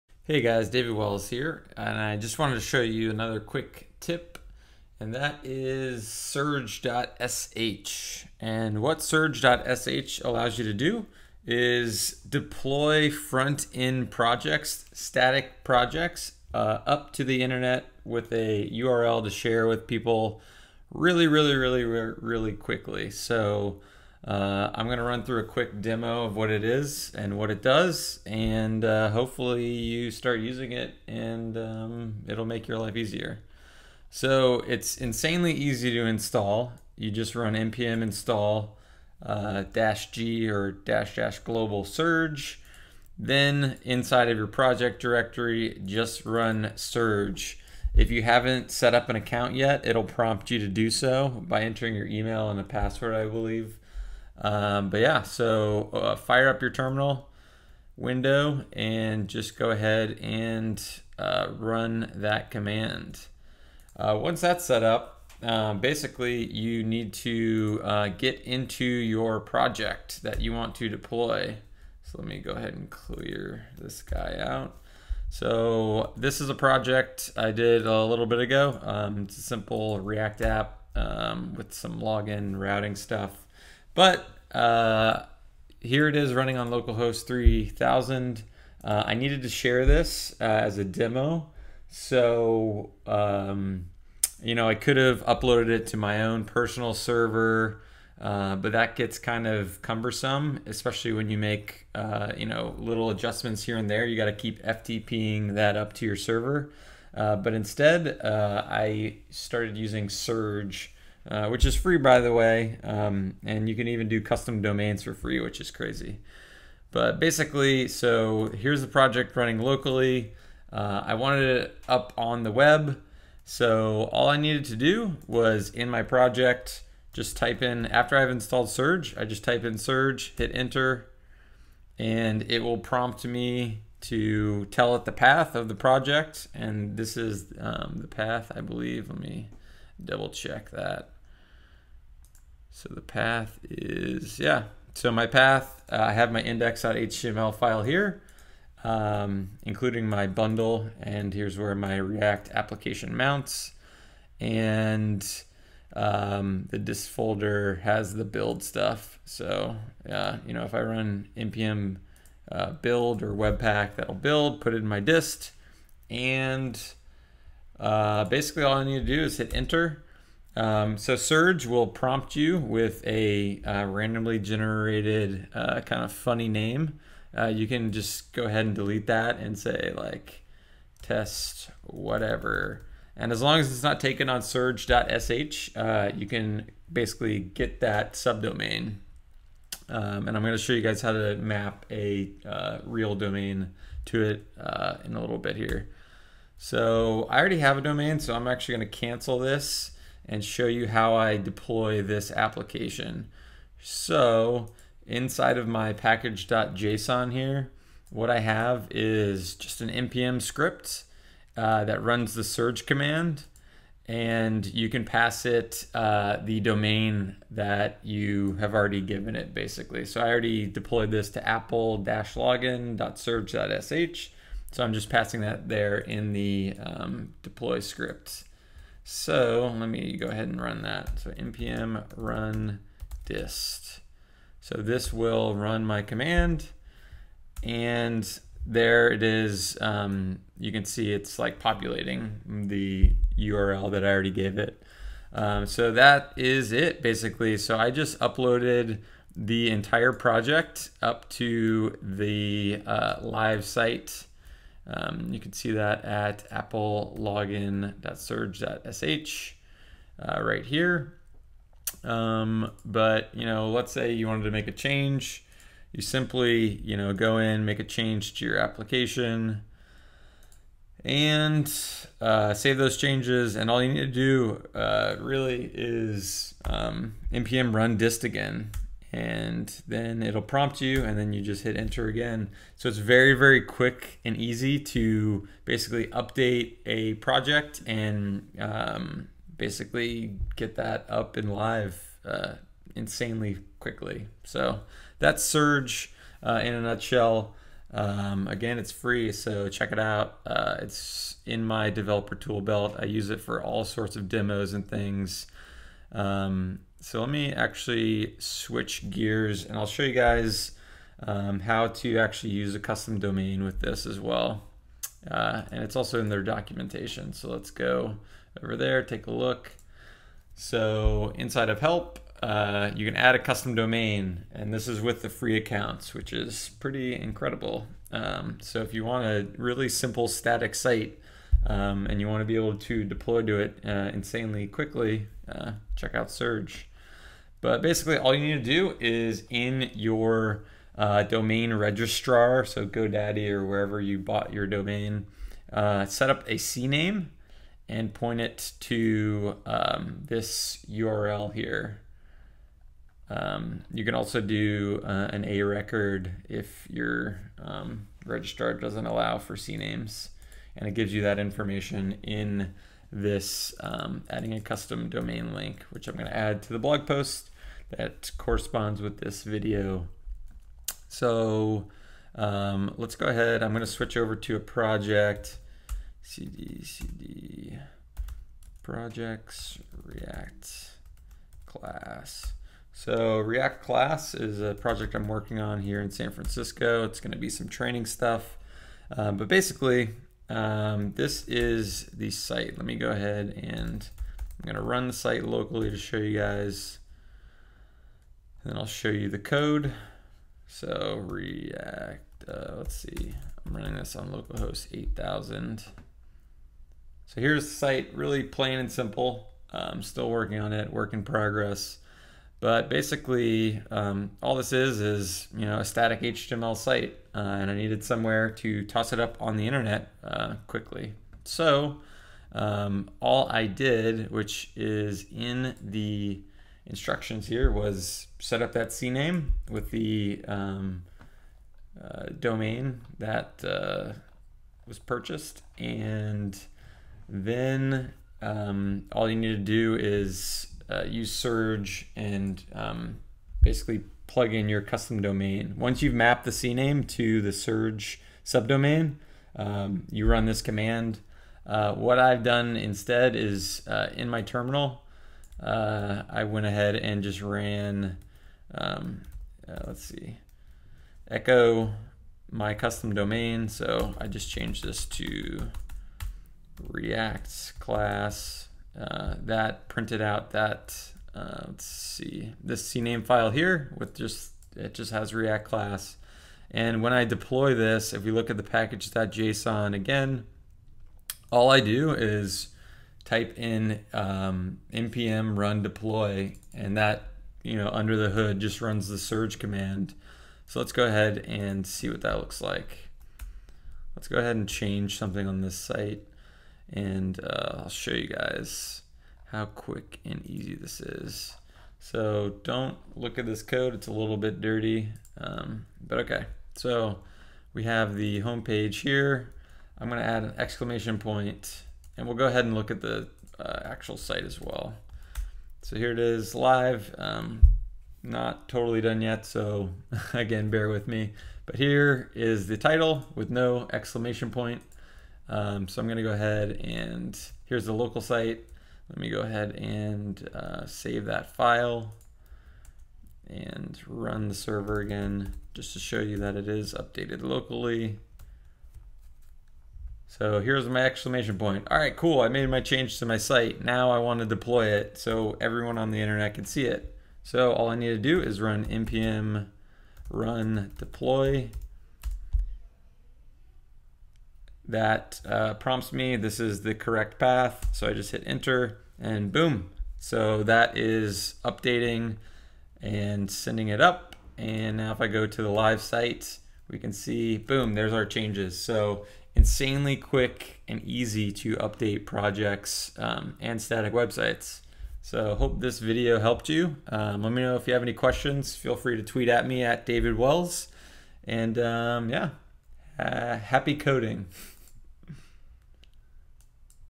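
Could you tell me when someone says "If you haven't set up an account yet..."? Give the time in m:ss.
0:47.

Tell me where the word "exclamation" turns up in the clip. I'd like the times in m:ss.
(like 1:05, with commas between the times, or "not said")
8:30, 8:43, 9:01.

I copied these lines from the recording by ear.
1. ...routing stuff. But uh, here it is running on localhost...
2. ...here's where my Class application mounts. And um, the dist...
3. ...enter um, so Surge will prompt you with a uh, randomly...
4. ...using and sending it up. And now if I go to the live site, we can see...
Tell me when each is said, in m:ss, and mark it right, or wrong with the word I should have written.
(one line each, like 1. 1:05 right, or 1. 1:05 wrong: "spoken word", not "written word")
1. 1:22 right
2. 2:31 wrong: "React", not "Class"
3. 2:49 right
4. 9:21 wrong: "updating", not "using".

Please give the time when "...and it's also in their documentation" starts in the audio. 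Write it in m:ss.
5:15.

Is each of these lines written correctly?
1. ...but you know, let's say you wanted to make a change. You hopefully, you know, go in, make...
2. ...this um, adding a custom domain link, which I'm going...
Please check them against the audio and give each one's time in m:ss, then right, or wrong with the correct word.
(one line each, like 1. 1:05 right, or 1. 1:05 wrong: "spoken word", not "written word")
1. 4:22 wrong: "simply", not "hopefully"
2. 6:03 right.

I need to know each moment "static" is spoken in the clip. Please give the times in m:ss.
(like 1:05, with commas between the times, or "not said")
0:14, 5:30, 6:55, 9:33.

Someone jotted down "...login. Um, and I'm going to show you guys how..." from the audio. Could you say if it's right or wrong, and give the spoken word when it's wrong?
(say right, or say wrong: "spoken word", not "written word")
wrong: "subdomain", not "login".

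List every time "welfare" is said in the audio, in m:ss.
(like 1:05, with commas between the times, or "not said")
not said.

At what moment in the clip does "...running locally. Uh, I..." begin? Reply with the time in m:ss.
1:59.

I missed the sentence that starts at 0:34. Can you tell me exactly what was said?
So it's insanely easy to install.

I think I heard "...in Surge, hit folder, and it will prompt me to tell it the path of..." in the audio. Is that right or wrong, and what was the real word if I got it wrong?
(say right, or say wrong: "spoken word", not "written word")
wrong: "enter", not "folder".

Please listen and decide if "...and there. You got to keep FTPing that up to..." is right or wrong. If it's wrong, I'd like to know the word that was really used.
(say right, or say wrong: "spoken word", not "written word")
right.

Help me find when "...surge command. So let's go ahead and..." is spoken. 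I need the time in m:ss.
8:09.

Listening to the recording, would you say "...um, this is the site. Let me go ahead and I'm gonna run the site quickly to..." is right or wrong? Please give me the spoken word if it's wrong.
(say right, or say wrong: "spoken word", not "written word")
wrong: "locally", not "quickly".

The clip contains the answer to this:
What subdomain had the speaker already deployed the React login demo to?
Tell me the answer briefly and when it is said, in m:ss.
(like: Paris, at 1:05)
apple-login.surge.sh, at 3:41.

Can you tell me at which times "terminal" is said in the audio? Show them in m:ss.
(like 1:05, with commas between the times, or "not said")
0:56, 7:34.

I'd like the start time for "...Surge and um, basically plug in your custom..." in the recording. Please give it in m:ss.
7:21.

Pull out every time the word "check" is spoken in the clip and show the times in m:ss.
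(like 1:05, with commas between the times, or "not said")
2:20, 4:59, 5:35.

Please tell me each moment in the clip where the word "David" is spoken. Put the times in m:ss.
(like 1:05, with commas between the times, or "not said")
0:00, 9:40.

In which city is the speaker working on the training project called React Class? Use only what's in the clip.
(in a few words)
San Francisco.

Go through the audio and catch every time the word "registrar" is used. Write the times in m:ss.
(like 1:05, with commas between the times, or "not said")
5:41, 5:58.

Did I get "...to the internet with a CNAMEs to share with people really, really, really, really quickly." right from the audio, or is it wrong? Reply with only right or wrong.
wrong.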